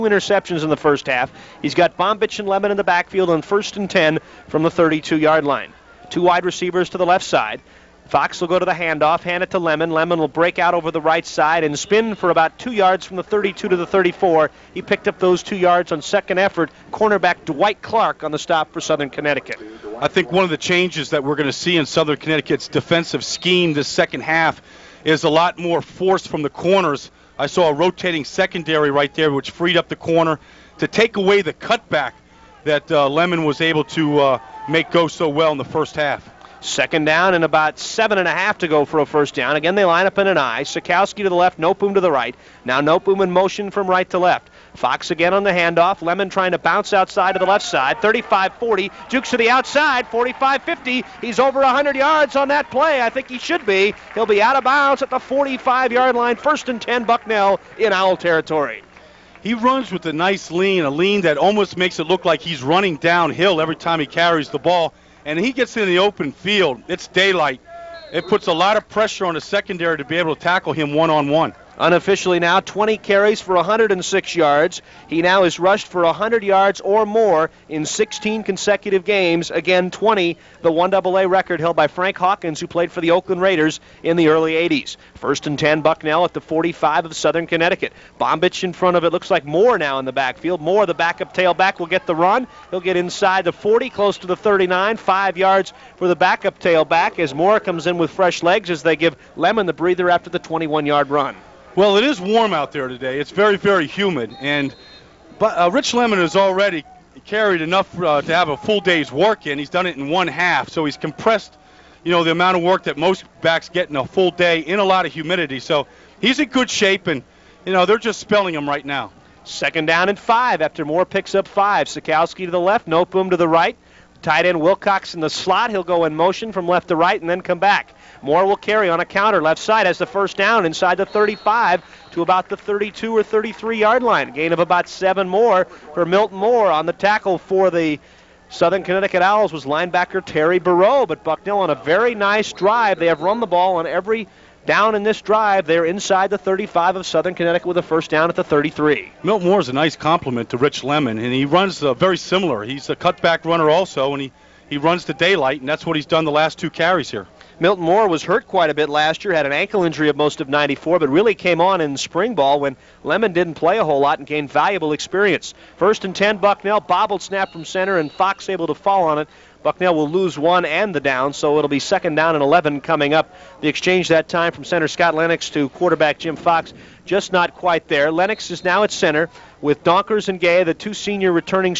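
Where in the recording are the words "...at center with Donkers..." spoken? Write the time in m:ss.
2:58.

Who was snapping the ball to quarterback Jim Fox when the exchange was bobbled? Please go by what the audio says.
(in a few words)
Scott Lennox.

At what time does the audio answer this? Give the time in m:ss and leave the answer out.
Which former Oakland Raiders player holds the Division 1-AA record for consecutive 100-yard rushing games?
1:21.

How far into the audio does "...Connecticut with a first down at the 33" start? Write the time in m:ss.
2:27.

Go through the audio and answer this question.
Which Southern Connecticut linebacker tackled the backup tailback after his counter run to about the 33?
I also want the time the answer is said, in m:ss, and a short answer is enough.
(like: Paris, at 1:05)
Terry Barreau, at 2:20.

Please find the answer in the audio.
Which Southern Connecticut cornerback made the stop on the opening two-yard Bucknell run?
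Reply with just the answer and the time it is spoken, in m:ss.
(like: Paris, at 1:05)
Dwight Clark, at 0:17.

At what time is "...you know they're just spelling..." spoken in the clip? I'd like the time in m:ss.
1:57.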